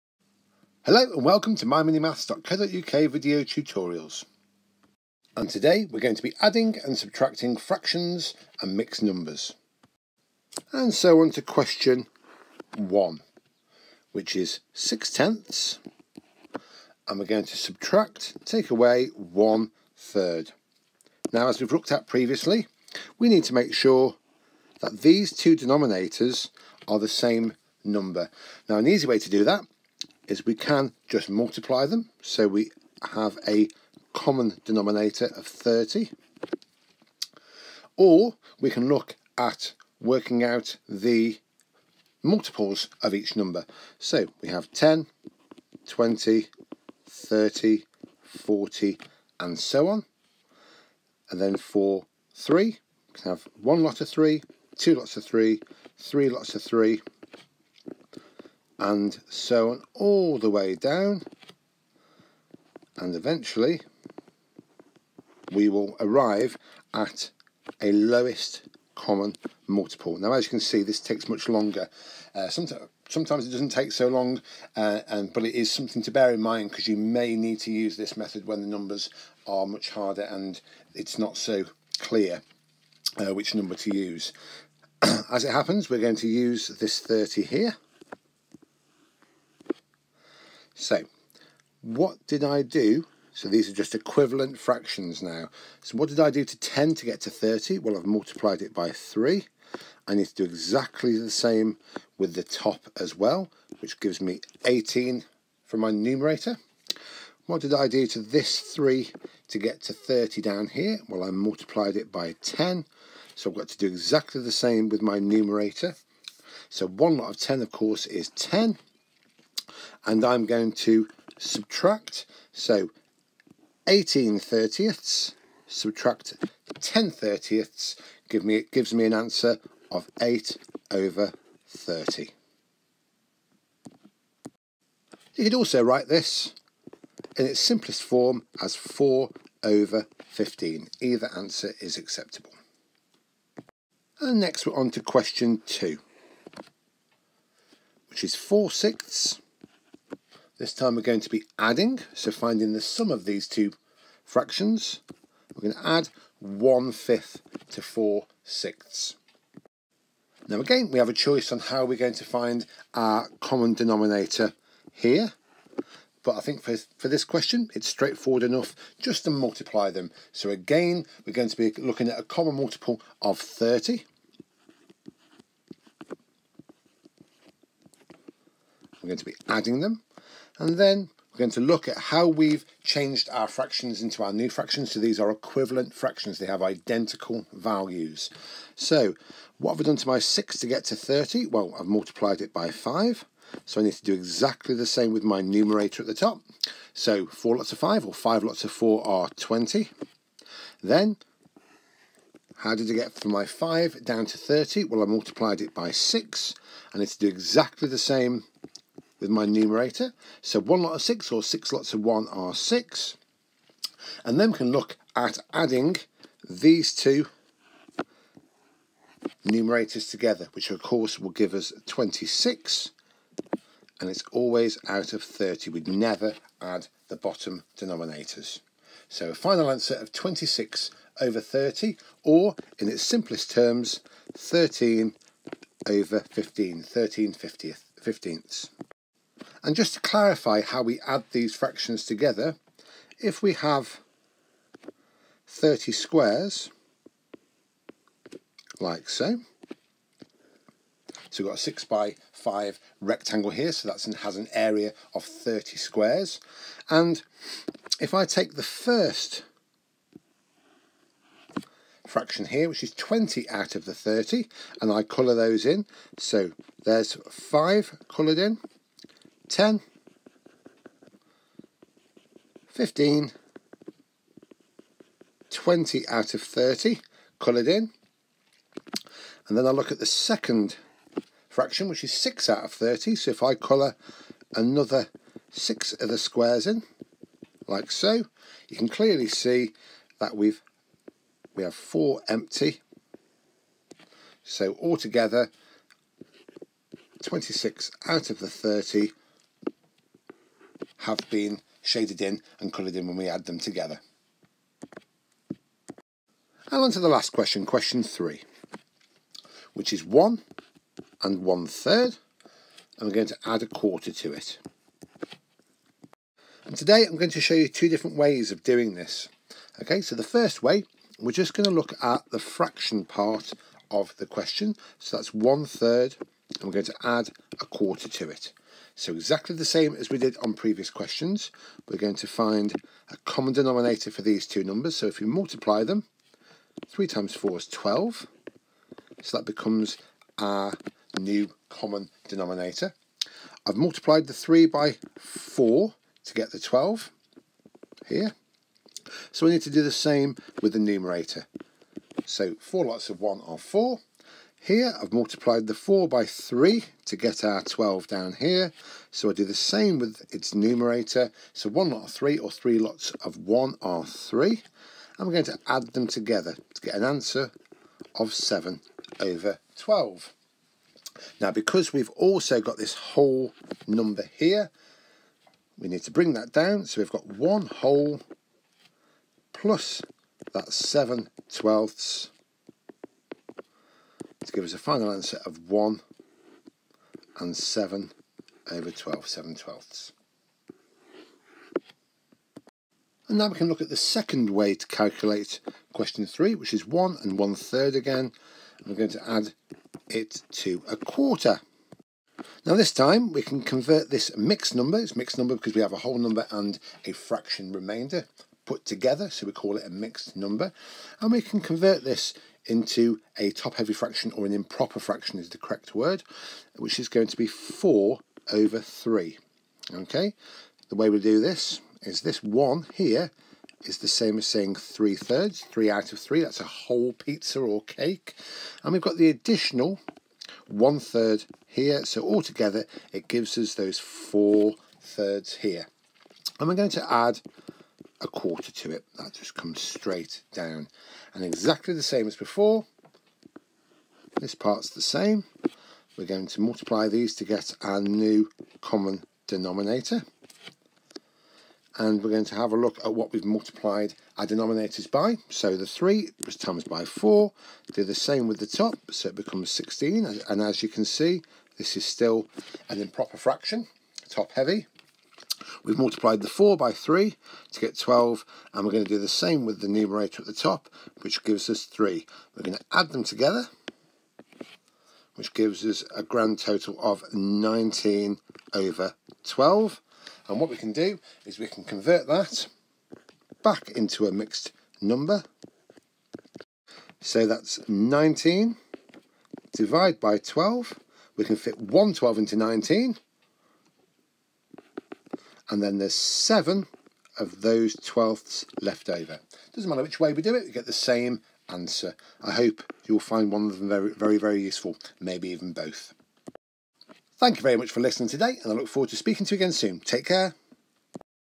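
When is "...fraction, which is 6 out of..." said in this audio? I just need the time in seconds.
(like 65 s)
281 s.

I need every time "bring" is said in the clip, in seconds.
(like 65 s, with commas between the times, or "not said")
376 s.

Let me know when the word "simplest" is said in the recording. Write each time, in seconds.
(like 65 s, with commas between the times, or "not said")
137 s, 233 s.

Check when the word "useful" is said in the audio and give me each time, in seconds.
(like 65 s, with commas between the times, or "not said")
504 s.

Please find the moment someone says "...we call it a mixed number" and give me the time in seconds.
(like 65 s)
409 s.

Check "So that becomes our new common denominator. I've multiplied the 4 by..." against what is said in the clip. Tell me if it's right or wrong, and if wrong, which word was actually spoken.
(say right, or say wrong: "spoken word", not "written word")
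wrong: "3", not "4".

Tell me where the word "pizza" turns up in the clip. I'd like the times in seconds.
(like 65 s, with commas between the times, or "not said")
427 s.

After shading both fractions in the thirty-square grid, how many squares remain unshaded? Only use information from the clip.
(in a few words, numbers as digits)
4.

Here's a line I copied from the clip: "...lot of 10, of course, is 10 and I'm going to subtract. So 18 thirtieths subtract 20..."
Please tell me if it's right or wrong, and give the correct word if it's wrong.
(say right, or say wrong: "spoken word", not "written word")
wrong: "10", not "20".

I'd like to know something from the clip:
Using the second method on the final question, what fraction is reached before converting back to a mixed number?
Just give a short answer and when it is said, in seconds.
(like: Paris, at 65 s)
19/12, at 477 s.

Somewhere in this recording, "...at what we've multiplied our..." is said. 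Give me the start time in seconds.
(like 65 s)
453 s.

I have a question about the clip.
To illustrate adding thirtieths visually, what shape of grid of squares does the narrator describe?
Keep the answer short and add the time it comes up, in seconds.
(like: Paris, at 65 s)
6 by 5 rectangle, at 251 s.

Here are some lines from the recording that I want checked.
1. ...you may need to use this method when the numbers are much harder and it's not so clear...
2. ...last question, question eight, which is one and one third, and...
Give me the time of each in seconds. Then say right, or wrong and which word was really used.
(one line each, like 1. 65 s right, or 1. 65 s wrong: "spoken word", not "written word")
1. 76 s right
2. 307 s wrong: "three", not "eight".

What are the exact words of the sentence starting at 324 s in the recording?
So that's one third, and we're going to add a quarter to it.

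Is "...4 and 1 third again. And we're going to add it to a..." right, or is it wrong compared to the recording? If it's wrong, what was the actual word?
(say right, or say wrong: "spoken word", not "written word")
wrong: "1", not "4".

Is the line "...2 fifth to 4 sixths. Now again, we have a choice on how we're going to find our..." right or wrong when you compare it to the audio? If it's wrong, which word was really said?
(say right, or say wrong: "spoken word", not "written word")
wrong: "1", not "2".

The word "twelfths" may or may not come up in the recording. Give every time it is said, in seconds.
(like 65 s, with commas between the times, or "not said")
381 s, 389 s, 498 s.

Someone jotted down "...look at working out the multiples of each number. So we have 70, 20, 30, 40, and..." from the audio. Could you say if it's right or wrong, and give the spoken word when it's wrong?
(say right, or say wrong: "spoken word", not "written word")
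wrong: "10", not "70".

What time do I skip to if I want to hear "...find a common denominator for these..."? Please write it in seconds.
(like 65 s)
332 s.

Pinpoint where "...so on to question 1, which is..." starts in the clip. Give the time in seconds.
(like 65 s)
10 s.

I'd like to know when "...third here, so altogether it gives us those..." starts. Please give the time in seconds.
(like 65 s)
430 s.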